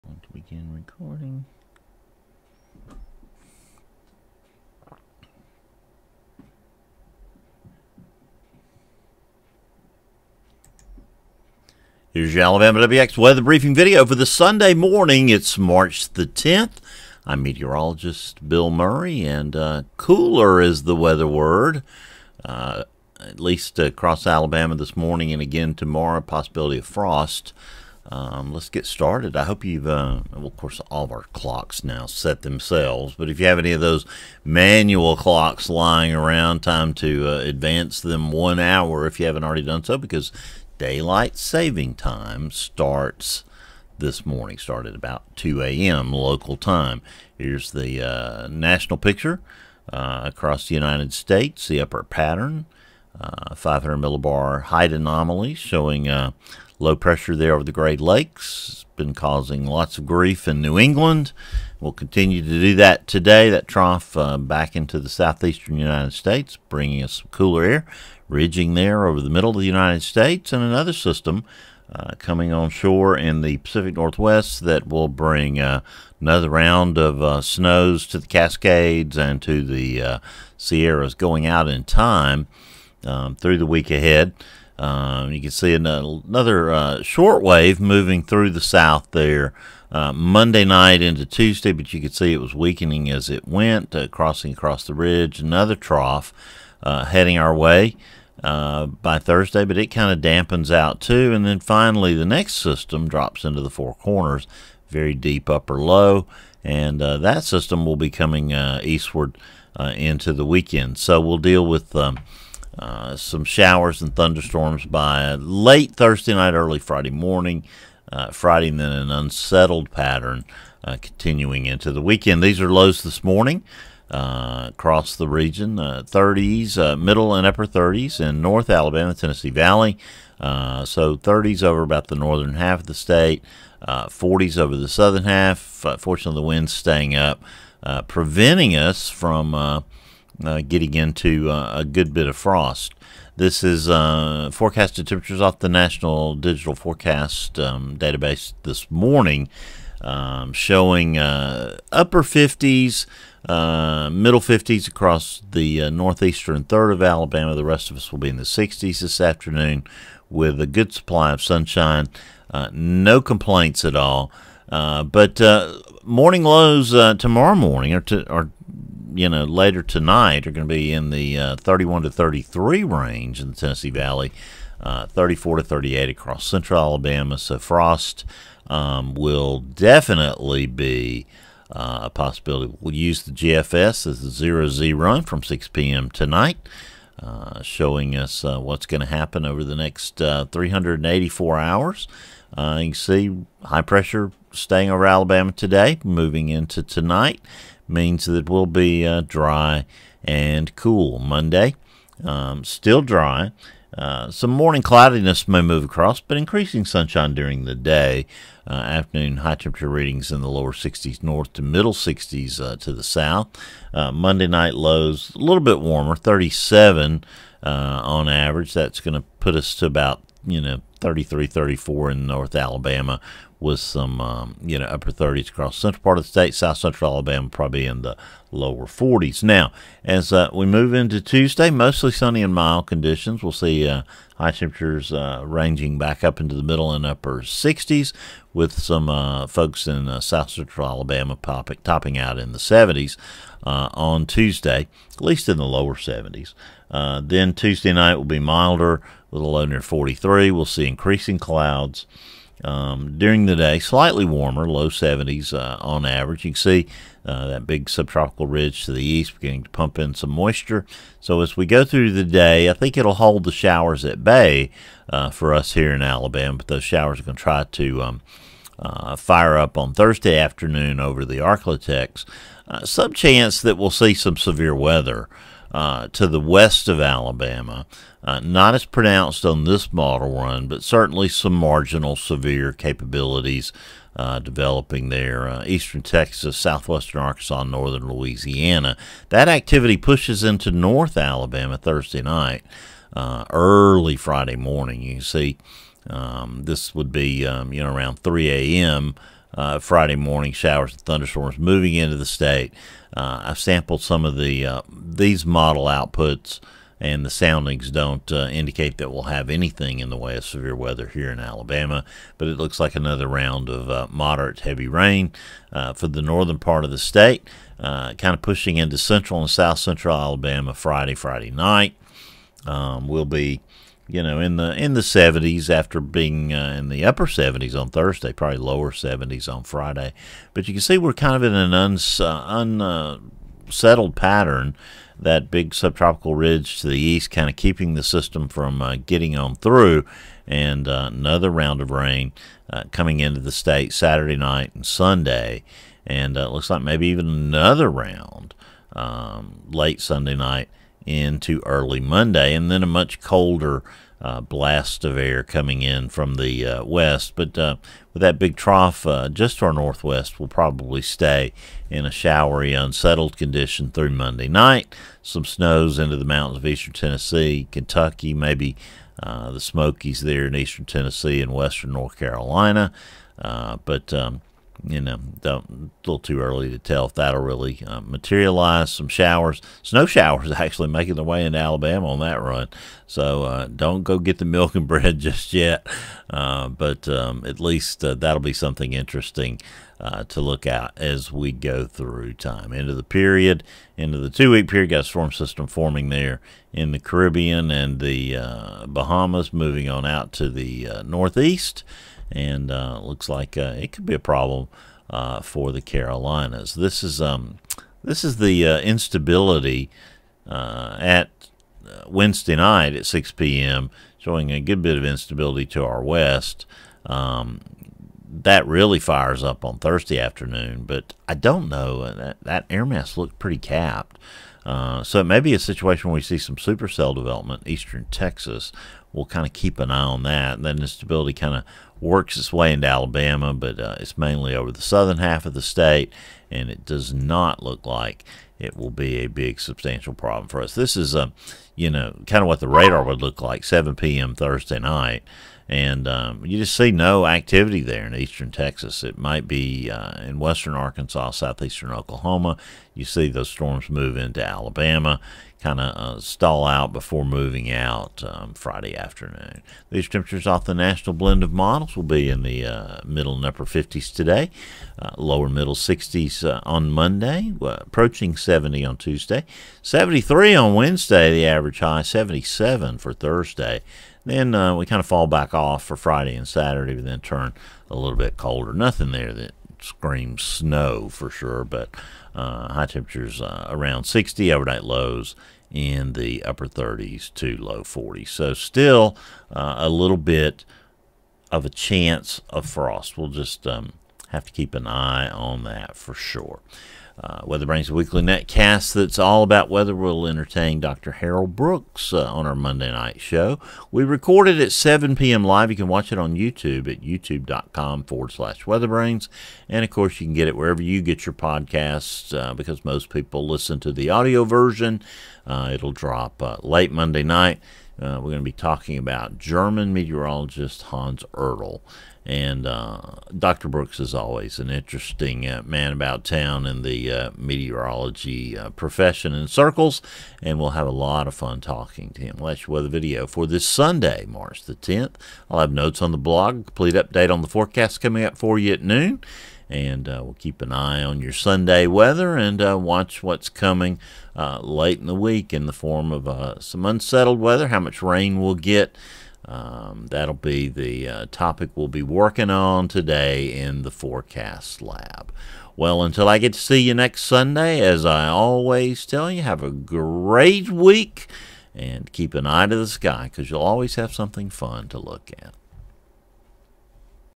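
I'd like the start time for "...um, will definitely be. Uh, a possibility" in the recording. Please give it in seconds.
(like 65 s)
178 s.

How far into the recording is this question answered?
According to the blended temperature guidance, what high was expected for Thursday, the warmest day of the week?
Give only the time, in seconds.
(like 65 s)
472 s.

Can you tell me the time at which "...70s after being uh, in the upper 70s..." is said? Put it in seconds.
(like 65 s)
325 s.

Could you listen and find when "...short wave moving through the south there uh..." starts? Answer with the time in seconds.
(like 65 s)
87 s.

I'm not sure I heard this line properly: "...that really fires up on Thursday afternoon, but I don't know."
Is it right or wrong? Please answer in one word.
right.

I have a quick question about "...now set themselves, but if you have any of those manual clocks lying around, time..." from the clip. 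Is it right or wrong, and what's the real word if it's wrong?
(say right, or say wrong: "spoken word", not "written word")
right.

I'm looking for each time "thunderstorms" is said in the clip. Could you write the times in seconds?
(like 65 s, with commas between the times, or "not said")
114 s, 301 s.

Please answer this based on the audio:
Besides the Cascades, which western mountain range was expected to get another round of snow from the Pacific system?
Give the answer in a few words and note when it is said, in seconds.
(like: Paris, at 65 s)
Sierras, at 80 s.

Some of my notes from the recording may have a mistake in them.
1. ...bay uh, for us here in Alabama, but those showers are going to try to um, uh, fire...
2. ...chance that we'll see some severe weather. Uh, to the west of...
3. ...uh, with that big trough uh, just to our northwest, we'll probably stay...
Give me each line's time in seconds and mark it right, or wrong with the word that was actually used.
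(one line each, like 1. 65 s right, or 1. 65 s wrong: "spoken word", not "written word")
1. 264 s right
2. 273 s right
3. 357 s right.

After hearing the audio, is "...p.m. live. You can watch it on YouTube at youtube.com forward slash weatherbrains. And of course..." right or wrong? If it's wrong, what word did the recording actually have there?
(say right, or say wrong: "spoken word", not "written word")
right.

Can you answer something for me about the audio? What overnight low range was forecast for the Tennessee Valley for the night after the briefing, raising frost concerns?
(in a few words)
31 to 33.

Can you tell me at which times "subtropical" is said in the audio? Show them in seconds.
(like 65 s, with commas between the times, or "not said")
257 s, 335 s.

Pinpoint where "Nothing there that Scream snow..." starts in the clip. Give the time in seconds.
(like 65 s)
478 s.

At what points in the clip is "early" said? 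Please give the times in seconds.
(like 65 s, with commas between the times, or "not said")
116 s, 293 s, 351 s, 376 s.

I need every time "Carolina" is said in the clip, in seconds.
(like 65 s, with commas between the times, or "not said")
372 s, 405 s.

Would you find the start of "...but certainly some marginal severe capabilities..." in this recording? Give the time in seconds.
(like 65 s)
280 s.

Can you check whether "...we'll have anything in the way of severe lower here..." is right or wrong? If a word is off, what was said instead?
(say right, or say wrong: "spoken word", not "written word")
wrong: "weather", not "lower".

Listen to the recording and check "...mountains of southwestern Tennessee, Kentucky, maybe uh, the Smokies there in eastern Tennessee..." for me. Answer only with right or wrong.
wrong.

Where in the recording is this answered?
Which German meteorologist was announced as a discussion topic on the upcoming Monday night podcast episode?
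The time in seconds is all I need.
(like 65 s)
520 s.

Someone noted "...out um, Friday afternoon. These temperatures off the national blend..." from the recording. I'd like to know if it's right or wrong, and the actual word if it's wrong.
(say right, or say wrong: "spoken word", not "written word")
right.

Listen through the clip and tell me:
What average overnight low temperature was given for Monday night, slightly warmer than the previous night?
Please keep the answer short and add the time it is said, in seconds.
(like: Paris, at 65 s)
37, at 216 s.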